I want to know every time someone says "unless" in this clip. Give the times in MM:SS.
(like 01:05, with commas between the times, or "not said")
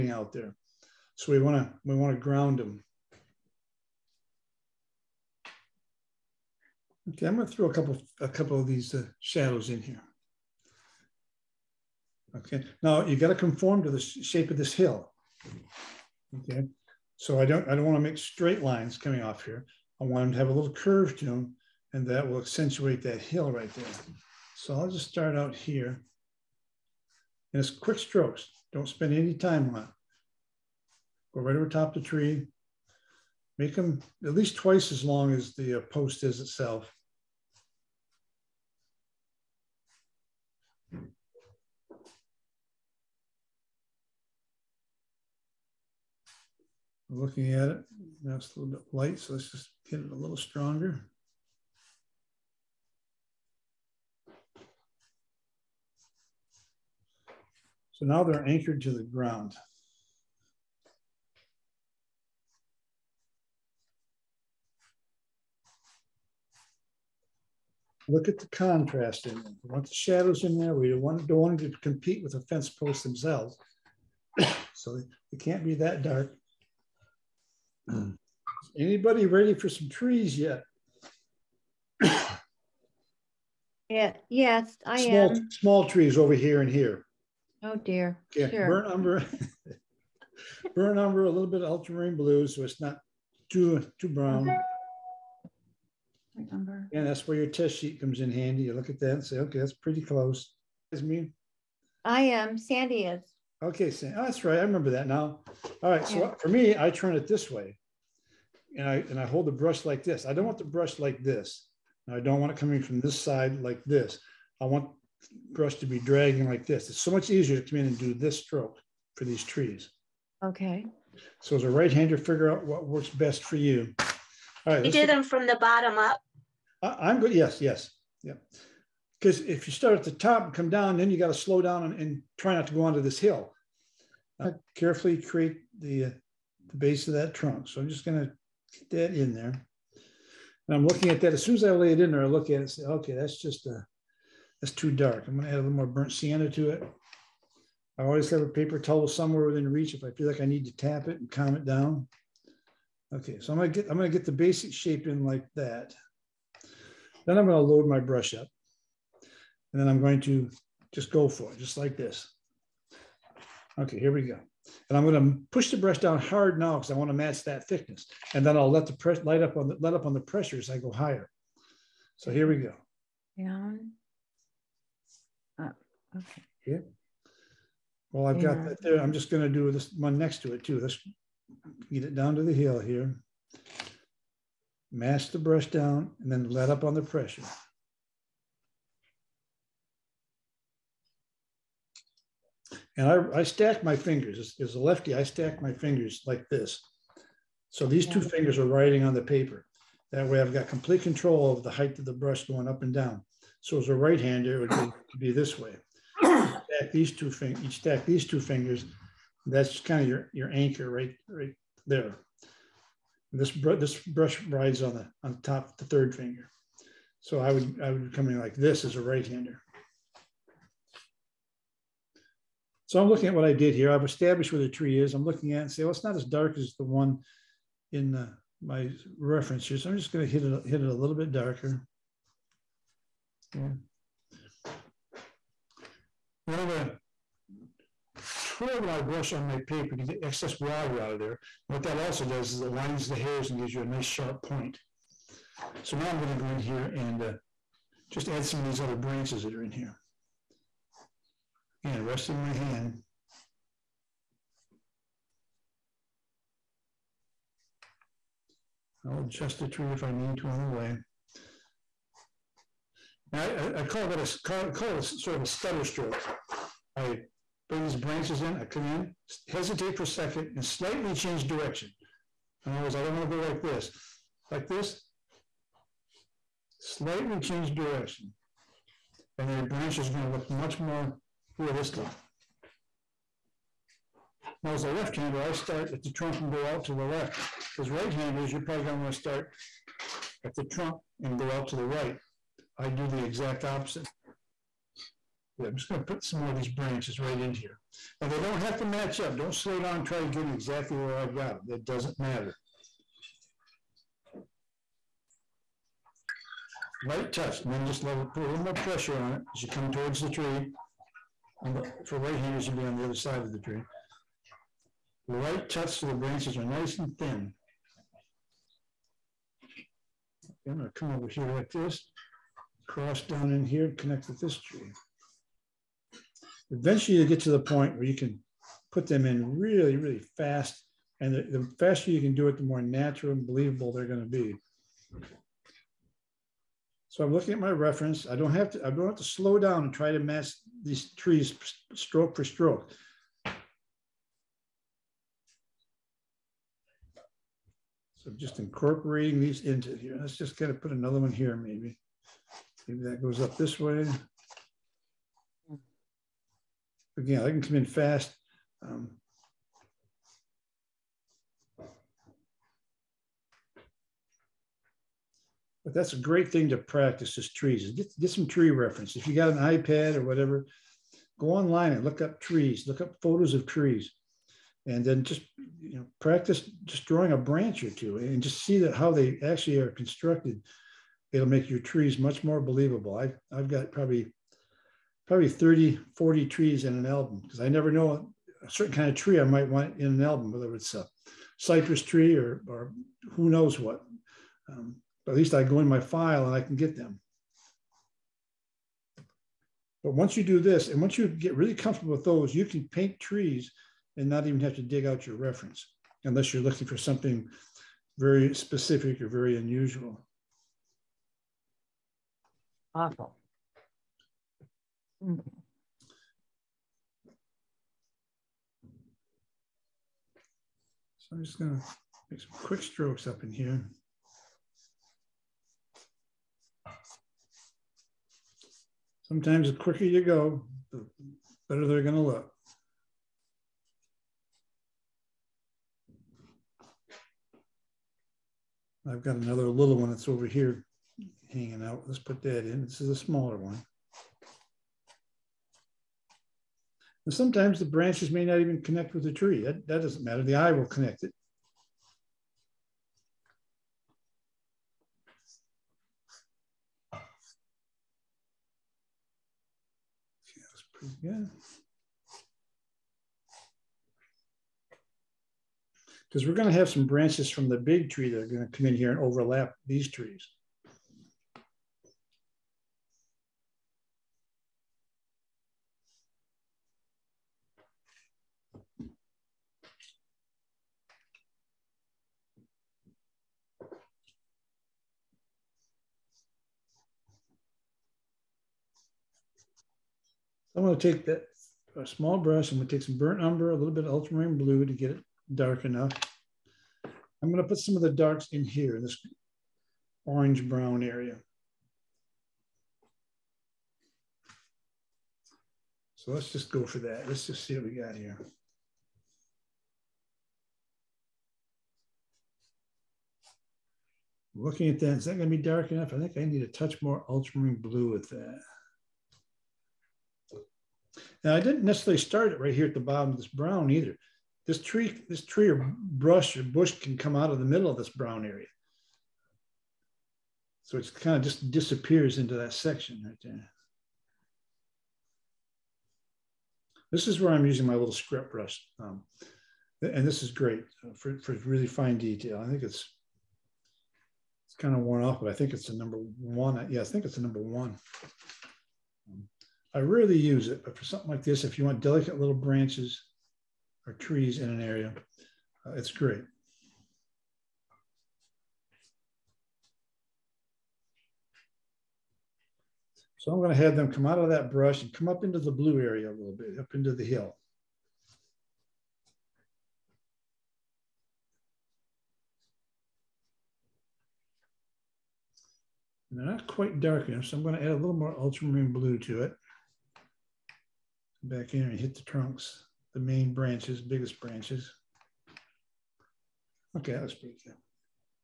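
06:46.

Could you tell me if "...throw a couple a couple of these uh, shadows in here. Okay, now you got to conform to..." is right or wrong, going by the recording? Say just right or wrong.
right.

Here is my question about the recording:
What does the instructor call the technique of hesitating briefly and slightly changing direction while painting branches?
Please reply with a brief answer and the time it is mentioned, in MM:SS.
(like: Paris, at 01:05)
stutter stroke, at 04:25.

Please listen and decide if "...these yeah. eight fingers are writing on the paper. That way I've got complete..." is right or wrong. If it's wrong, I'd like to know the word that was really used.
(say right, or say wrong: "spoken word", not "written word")
wrong: "two", not "eight".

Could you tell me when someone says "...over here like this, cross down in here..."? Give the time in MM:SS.
05:21.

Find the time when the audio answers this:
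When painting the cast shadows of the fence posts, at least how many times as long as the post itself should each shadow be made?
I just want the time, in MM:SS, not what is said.
00:34.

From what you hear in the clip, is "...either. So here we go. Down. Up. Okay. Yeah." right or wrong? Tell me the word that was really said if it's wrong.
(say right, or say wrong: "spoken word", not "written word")
wrong: "higher", not "either".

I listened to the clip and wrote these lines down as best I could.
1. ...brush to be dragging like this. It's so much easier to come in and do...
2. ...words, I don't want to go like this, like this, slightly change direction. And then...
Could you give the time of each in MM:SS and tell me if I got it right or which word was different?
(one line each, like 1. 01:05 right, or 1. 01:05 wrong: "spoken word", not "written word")
1. 01:55 right
2. 04:32 right.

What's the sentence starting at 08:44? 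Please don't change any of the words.
This tree, this tree or brush or bush can come out of the middle of this brown area.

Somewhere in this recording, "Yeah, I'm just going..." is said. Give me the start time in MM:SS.
04:55.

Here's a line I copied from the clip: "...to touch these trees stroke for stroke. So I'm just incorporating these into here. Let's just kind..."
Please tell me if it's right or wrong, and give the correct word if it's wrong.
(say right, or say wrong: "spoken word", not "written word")
wrong: "match", not "touch".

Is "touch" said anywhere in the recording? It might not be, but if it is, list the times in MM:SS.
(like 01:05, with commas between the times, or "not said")
05:07, 08:36.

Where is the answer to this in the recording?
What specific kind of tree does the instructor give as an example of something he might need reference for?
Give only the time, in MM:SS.
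06:31.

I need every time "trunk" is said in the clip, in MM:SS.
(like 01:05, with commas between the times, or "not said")
02:17, 04:46, 04:50, 09:42.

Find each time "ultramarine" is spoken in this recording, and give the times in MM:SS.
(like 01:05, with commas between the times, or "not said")
01:31, 08:14, 08:37, 09:38.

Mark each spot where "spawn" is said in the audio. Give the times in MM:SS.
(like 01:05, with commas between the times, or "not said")
not said.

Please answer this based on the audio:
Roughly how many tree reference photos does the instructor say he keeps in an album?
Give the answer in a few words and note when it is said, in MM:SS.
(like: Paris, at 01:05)
30 to 40, at 06:25.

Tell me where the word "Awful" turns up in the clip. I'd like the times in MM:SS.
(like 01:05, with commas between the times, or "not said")
06:52.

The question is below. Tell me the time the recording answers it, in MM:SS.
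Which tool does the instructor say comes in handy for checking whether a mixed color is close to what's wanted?
01:37.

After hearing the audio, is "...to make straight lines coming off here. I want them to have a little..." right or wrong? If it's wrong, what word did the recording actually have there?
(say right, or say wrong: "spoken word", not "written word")
right.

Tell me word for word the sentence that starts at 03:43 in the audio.
I've established where the tree is.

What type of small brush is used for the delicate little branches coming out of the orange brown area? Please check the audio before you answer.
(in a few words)
script brush.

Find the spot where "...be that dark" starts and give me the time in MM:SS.
01:15.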